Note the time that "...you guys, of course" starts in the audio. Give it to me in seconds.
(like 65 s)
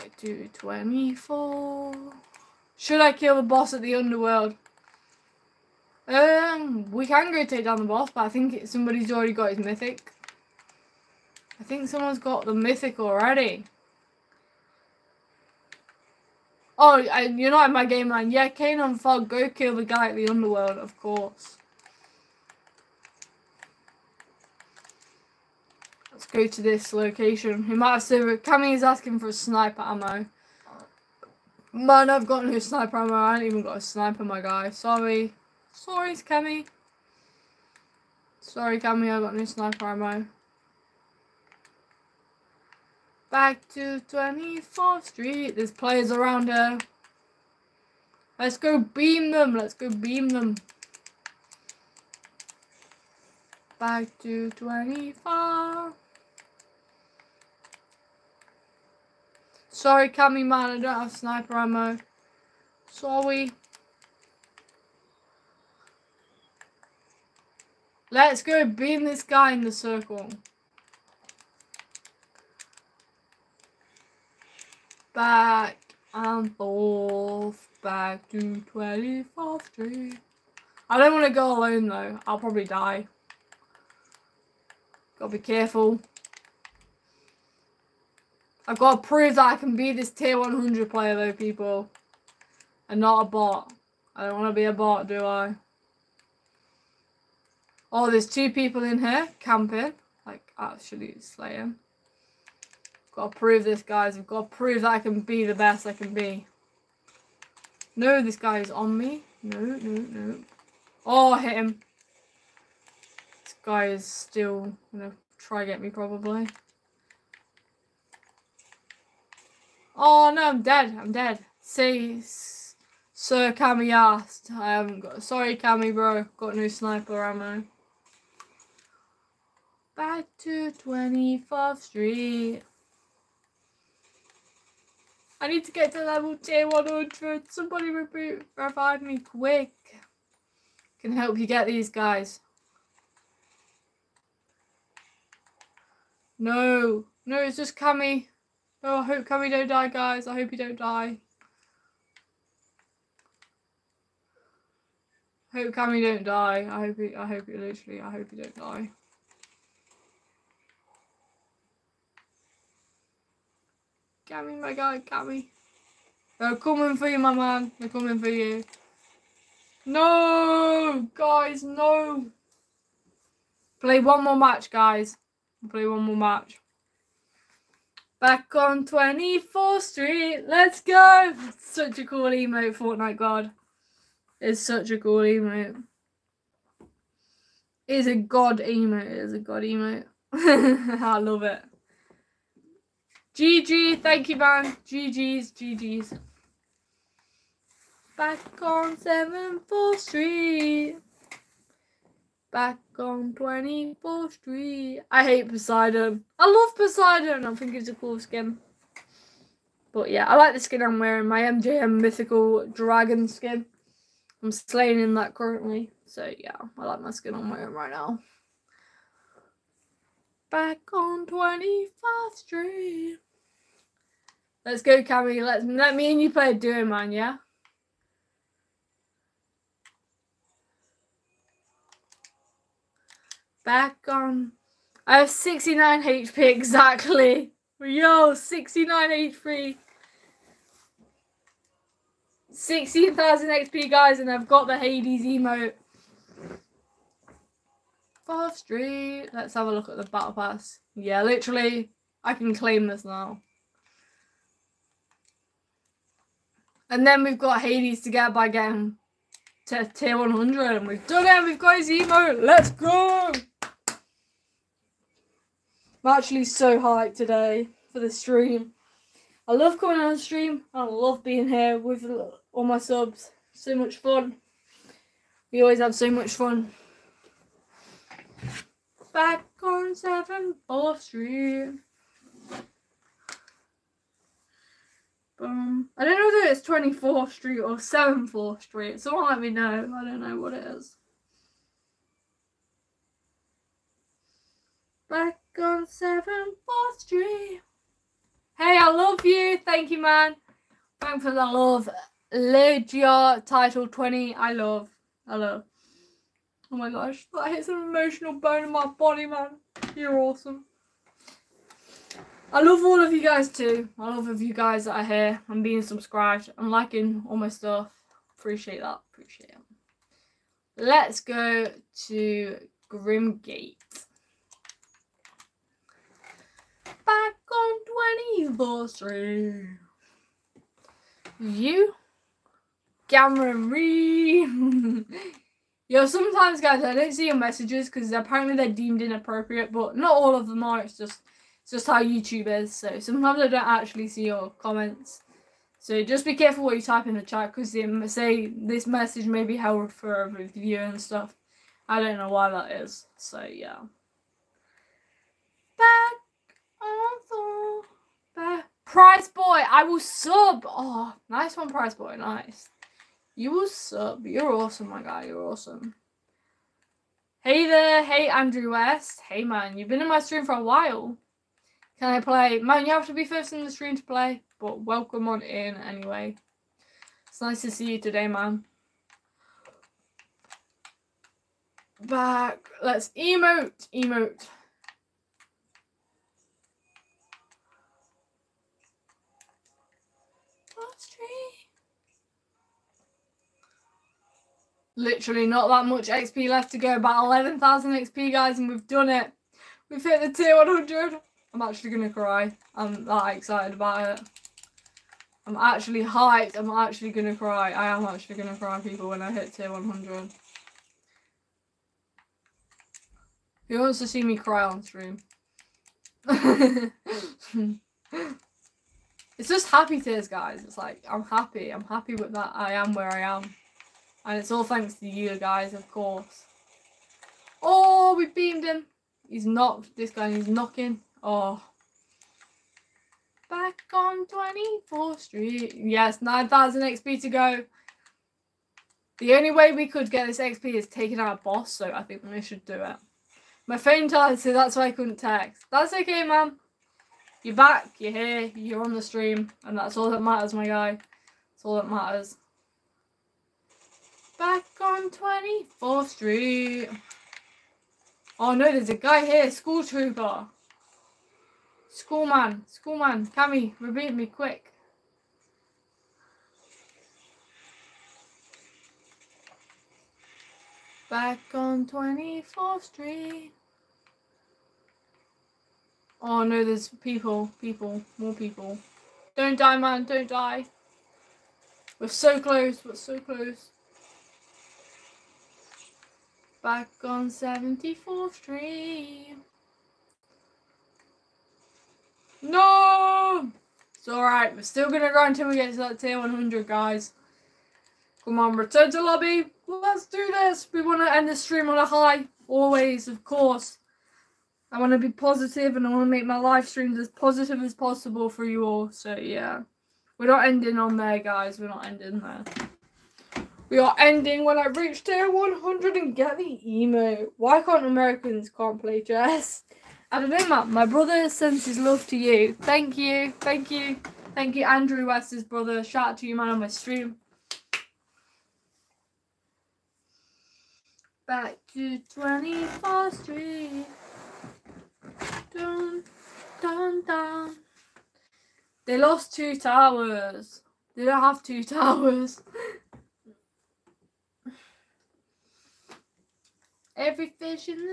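425 s.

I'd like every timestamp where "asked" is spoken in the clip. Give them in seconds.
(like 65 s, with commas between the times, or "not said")
123 s.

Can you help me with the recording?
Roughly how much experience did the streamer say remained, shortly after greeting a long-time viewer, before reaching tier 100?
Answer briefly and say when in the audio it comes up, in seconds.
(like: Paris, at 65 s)
11,000 XP, at 397 s.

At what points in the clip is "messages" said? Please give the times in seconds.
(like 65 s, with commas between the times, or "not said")
337 s, 348 s.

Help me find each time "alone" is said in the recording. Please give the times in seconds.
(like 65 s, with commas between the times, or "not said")
81 s.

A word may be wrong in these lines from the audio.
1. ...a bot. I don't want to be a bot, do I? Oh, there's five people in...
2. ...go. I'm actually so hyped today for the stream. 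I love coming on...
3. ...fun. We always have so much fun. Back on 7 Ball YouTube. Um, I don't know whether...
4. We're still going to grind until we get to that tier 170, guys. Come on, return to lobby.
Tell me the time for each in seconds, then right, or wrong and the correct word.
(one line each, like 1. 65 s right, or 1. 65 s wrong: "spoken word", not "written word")
1. 93 s wrong: "two", not "five"
2. 262 s right
3. 273 s wrong: "Street", not "YouTube"
4. 494 s wrong: "100", not "170".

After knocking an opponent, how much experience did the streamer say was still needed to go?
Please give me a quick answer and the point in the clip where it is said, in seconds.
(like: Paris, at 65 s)
9,000 XP, at 436 s.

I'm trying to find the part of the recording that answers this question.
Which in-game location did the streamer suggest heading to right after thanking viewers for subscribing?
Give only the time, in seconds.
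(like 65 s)
322 s.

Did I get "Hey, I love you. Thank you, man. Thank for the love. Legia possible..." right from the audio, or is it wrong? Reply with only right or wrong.
wrong.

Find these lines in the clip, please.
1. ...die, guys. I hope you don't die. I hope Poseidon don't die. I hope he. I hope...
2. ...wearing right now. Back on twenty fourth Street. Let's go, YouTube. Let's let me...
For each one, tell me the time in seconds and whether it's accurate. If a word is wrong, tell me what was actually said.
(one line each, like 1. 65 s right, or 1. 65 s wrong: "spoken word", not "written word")
1. 149 s wrong: "Cammy", not "Poseidon"
2. 217 s wrong: "Cammy", not "YouTube".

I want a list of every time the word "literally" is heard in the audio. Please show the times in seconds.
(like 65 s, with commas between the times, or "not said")
157 s, 251 s, 394 s.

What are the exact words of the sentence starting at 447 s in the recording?
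You're back, you're here, you're on the stream, and that's all that matters, my guy.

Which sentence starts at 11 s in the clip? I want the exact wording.
I think someone's got the mythic already.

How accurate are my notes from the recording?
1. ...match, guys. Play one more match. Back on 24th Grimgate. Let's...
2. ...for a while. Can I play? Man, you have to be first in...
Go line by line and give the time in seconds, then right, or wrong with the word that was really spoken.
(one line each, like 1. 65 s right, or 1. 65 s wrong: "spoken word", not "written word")
1. 174 s wrong: "Street", not "Grimgate"
2. 370 s right.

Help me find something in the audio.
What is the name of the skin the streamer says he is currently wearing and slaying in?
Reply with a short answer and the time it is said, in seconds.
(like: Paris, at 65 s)
MJM Mythical Dragon, at 211 s.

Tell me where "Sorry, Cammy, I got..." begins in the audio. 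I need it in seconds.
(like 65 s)
38 s.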